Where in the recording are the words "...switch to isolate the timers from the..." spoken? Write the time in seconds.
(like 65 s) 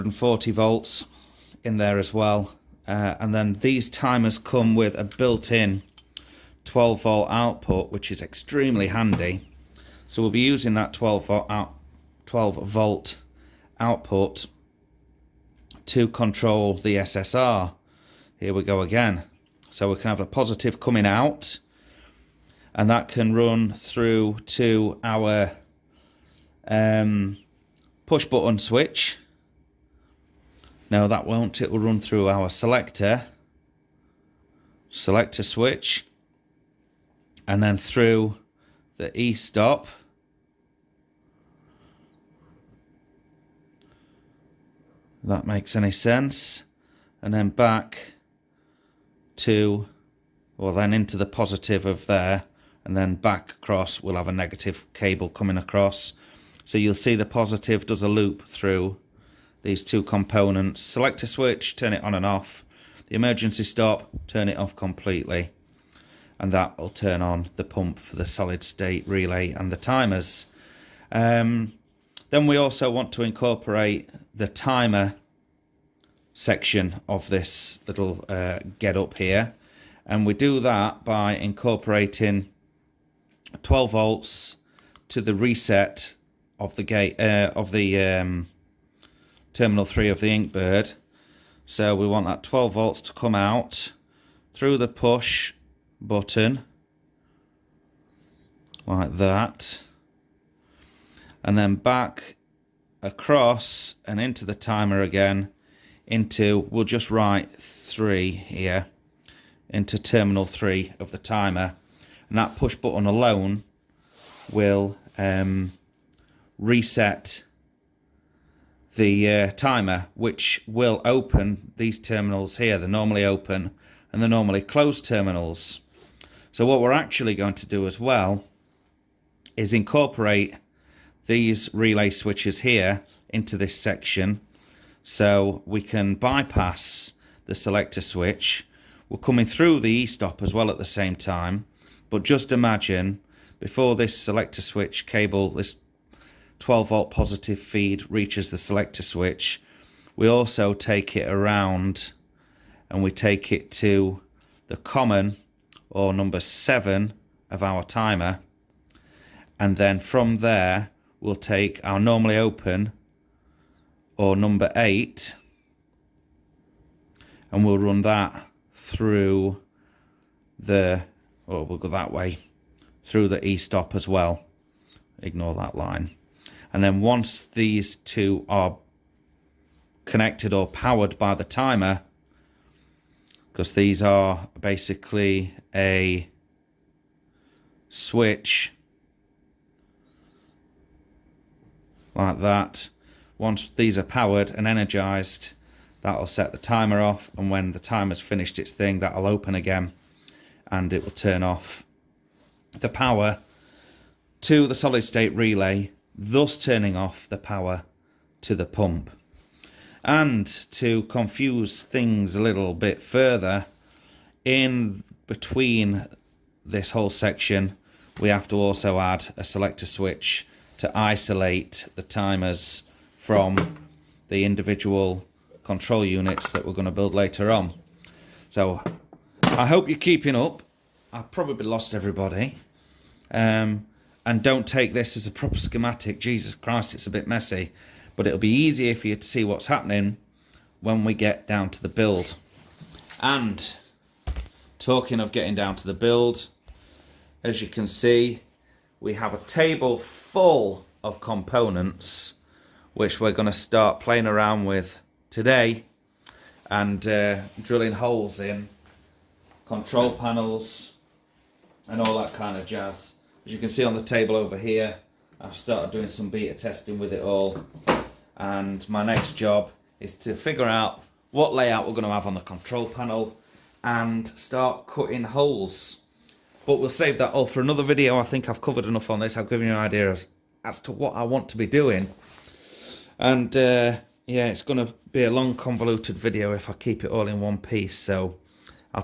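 219 s.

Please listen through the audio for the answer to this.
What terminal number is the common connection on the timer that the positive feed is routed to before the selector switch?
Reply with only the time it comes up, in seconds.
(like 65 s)
156 s.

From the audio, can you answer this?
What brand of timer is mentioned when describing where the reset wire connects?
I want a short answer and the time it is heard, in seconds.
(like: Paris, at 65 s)
Inkbird, at 90 s.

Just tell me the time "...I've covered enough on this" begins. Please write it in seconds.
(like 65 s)
278 s.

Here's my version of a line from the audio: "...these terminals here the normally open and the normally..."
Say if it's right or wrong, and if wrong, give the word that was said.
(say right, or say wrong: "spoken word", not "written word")
right.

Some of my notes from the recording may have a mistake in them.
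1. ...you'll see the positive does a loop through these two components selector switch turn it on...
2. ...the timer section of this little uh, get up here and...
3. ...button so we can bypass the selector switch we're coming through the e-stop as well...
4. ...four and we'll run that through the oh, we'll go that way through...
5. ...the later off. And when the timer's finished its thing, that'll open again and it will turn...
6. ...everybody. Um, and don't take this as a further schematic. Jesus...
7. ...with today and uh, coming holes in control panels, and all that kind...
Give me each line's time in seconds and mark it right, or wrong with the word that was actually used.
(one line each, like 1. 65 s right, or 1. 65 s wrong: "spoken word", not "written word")
1. 56 s right
2. 74 s right
3. 133 s wrong: "section", not "button"
4. 164 s wrong: "eight", not "four"
5. 196 s wrong: "timer", not "later"
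6. 231 s wrong: "proper", not "further"
7. 254 s wrong: "drilling", not "coming".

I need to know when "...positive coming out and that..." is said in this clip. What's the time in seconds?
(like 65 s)
20 s.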